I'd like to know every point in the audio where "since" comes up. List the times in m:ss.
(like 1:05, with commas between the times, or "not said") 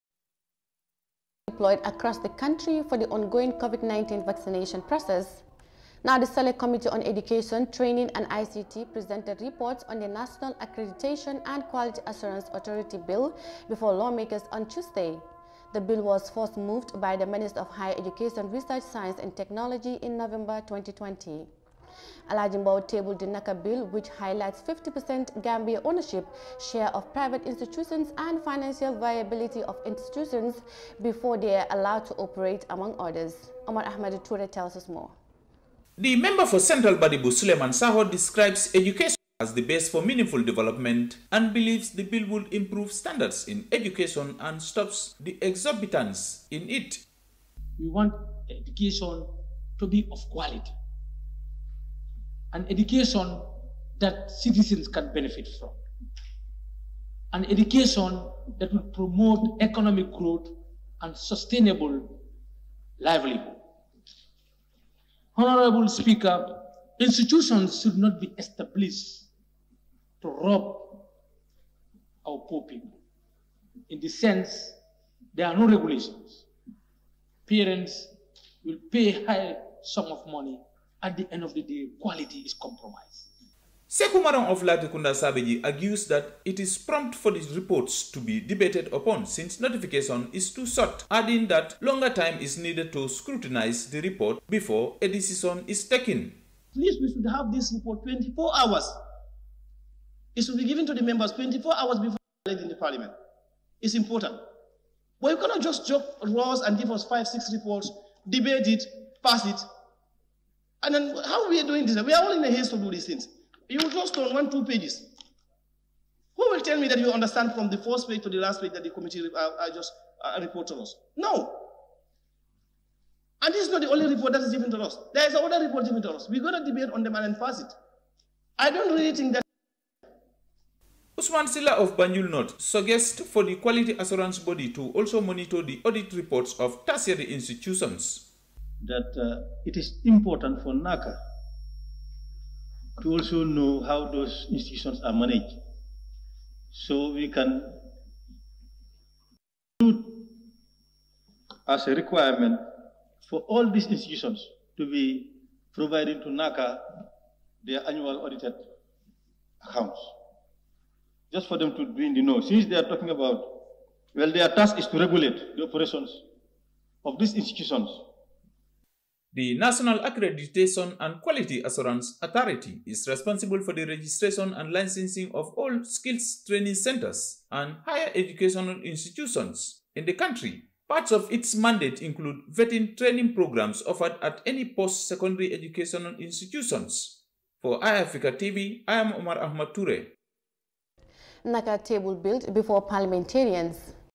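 1:29, 2:42.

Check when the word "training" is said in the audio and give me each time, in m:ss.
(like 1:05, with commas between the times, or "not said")
0:07, 2:56, 3:02.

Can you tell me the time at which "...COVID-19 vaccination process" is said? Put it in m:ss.
0:03.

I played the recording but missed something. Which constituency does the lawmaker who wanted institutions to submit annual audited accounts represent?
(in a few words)
Banjul North.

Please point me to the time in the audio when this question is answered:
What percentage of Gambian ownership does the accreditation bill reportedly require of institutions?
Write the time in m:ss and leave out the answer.
0:24.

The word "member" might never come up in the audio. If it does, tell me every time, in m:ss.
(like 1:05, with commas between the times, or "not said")
0:36, 1:41.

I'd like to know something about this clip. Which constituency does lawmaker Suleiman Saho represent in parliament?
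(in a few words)
Central Badibu.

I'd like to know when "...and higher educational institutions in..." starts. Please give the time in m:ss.
2:57.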